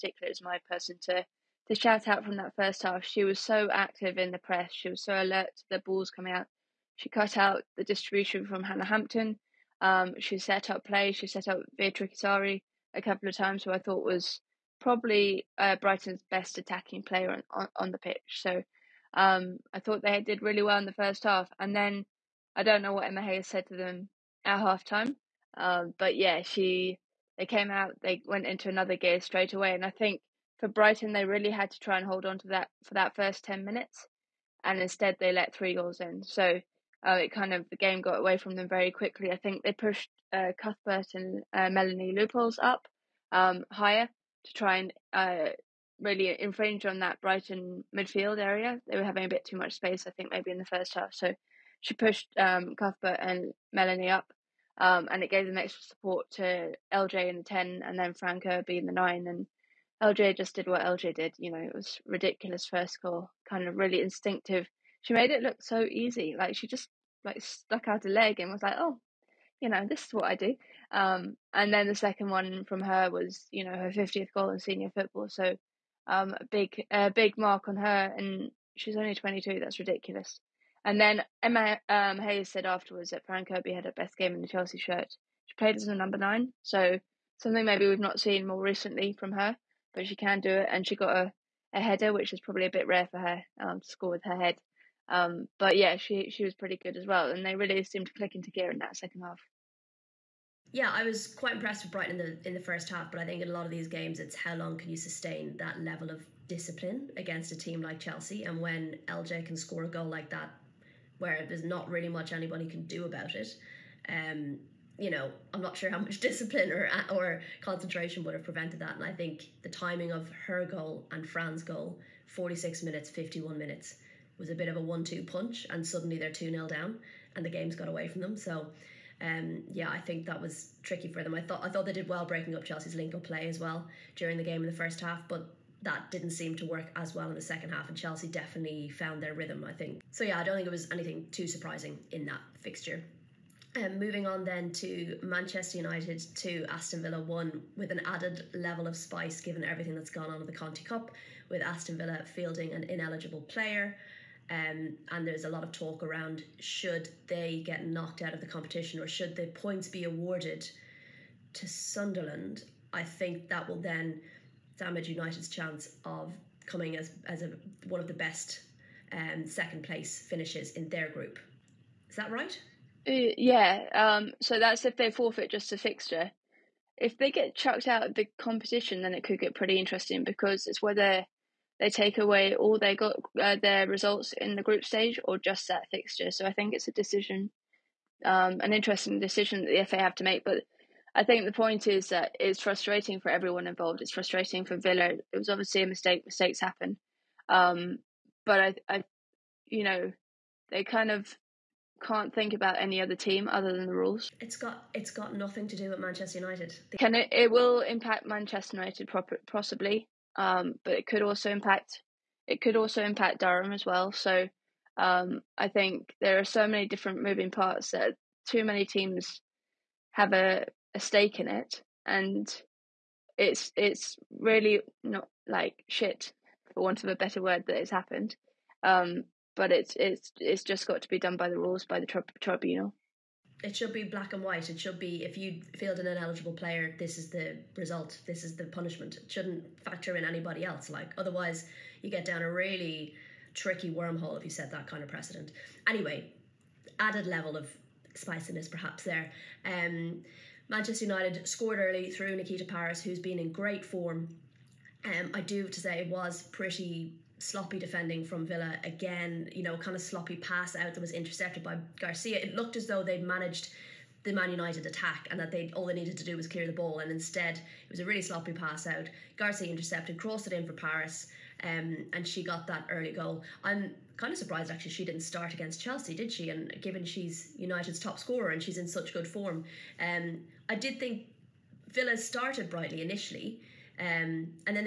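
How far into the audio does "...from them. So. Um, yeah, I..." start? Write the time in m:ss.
2:08.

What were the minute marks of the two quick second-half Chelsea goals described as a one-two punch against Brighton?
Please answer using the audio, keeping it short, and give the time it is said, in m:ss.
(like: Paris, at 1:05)
46 and 51 minutes, at 2:02.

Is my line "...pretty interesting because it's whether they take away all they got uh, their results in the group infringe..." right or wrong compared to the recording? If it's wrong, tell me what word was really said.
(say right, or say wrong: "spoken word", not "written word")
wrong: "stage", not "infringe".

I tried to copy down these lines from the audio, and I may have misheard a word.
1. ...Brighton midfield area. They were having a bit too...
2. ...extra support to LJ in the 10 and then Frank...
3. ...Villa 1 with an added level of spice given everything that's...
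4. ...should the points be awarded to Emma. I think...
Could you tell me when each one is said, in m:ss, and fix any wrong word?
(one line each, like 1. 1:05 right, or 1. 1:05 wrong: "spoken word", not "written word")
1. 0:47 right
2. 0:55 right
3. 2:27 right
4. 2:39 wrong: "Sunderland", not "Emma".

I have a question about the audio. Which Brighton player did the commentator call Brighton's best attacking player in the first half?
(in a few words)
Veatriki Sarri.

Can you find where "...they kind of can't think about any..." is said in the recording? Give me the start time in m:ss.
3:20.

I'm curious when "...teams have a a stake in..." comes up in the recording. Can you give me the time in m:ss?
3:38.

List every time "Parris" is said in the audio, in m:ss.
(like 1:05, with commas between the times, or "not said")
4:12, 4:30.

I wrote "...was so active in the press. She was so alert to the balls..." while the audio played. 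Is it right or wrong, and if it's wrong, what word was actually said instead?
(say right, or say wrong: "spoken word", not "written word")
right.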